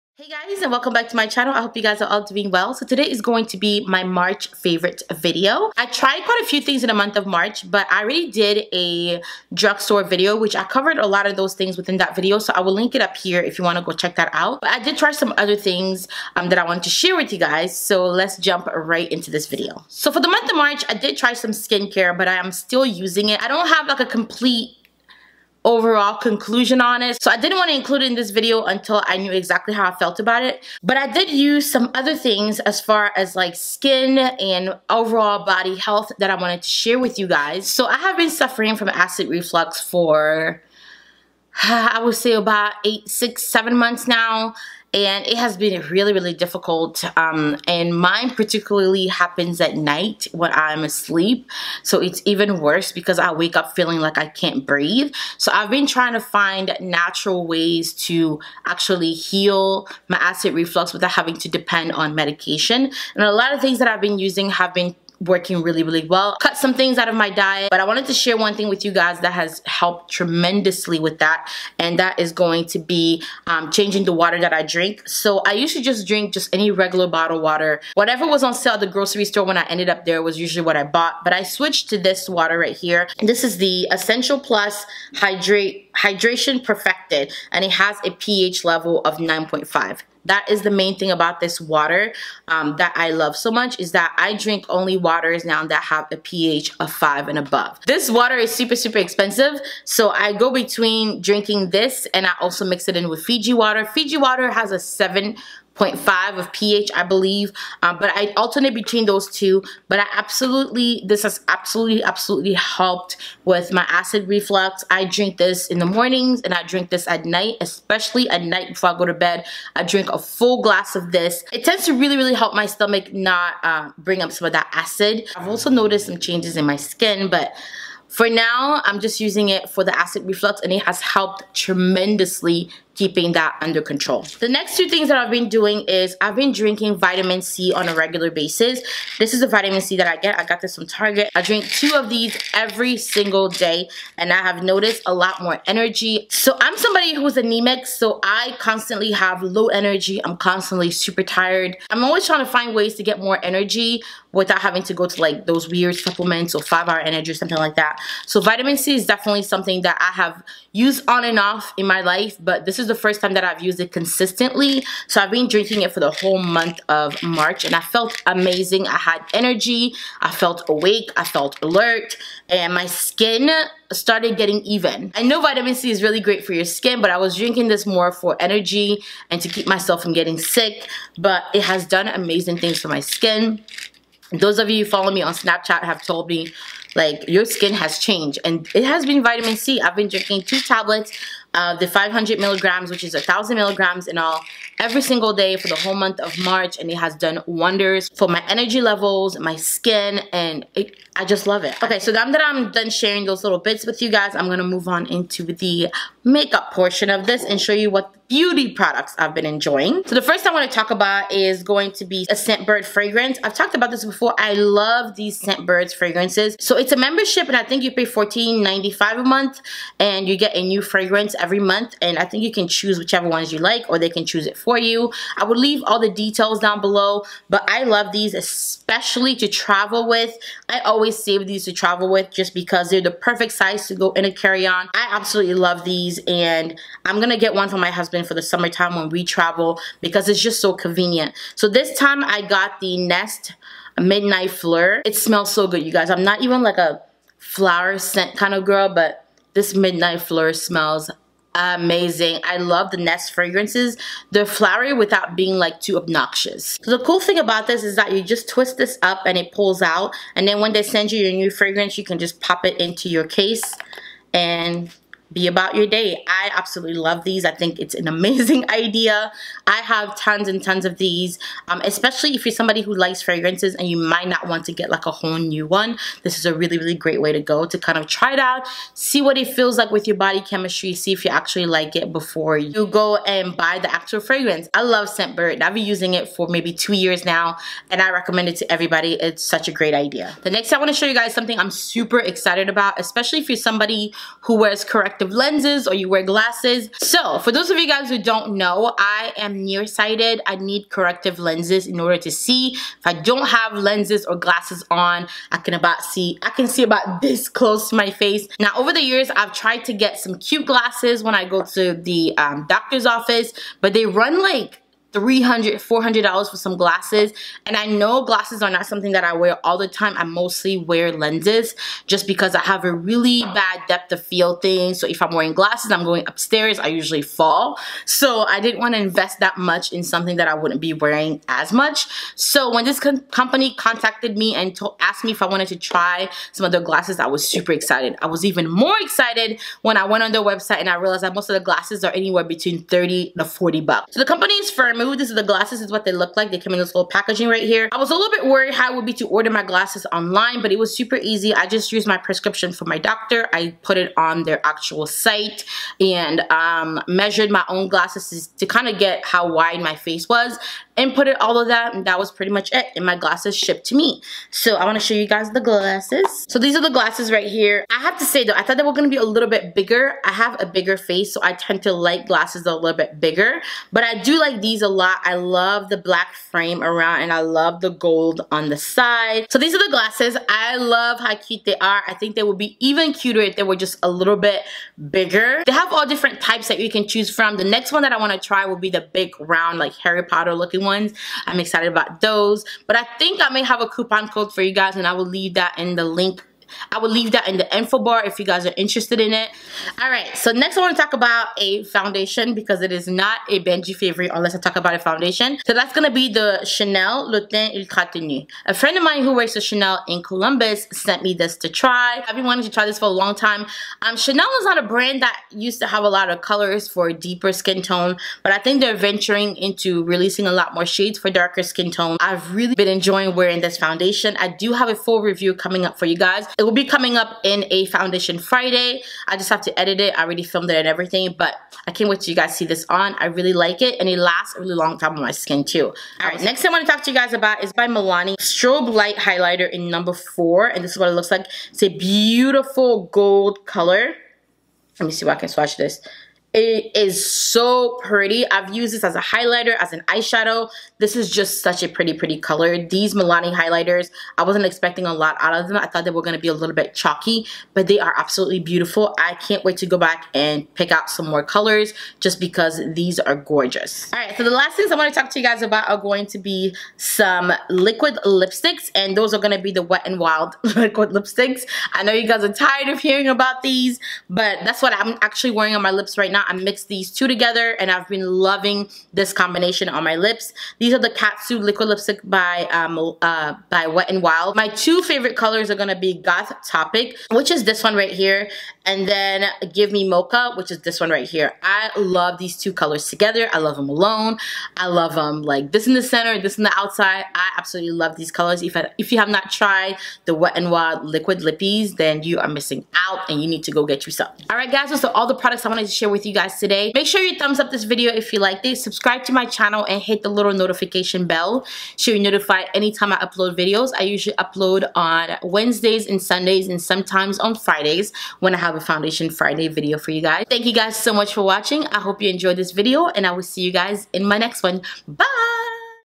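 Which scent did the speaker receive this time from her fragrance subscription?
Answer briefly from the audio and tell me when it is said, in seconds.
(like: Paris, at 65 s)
Nest Midnight Fleur, at 242 s.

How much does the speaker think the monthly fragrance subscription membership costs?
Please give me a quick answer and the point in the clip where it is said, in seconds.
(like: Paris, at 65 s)
$14.95, at 218 s.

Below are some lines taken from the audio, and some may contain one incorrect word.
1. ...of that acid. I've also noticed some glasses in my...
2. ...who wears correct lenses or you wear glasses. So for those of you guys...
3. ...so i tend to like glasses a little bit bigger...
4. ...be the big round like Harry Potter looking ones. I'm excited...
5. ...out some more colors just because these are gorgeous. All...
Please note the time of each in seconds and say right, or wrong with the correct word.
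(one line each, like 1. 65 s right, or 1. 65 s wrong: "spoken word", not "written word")
1. 124 s wrong: "changes", not "glasses"
2. 294 s right
3. 371 s right
4. 388 s right
5. 460 s right.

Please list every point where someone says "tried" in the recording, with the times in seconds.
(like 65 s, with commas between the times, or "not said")
5 s, 309 s, 499 s.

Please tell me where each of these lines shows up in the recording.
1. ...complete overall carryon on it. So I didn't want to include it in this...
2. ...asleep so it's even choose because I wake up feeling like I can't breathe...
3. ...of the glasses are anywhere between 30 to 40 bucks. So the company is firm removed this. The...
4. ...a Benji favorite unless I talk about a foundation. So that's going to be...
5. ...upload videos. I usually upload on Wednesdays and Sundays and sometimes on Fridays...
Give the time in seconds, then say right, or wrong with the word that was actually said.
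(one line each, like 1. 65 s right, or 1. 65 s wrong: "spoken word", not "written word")
1. 24 s wrong: "conclusion", not "carryon"
2. 50 s wrong: "worse", not "choose"
3. 341 s right
4. 403 s right
5. 513 s right.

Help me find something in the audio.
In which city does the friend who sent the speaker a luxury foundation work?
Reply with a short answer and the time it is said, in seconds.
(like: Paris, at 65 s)
Columbus, at 410 s.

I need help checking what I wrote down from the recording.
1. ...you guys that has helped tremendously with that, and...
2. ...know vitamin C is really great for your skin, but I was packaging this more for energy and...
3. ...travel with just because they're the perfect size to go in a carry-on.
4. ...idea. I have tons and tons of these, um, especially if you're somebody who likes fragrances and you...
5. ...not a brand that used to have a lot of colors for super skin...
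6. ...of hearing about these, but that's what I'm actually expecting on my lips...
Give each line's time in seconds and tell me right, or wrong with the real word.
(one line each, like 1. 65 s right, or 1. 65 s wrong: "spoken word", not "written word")
1. 68 s right
2. 175 s wrong: "drinking", not "packaging"
3. 231 s right
4. 268 s right
5. 414 s wrong: "deeper", not "super"
6. 472 s wrong: "wearing", not "expecting".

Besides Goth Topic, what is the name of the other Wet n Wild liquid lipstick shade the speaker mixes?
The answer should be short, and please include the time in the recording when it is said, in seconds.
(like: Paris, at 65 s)
Give Me Mocha, at 489 s.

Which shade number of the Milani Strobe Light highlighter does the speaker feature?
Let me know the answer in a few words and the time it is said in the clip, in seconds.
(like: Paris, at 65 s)
4, at 439 s.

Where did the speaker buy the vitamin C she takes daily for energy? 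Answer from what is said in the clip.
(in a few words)
Target.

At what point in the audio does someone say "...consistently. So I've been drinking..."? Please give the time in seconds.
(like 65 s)
163 s.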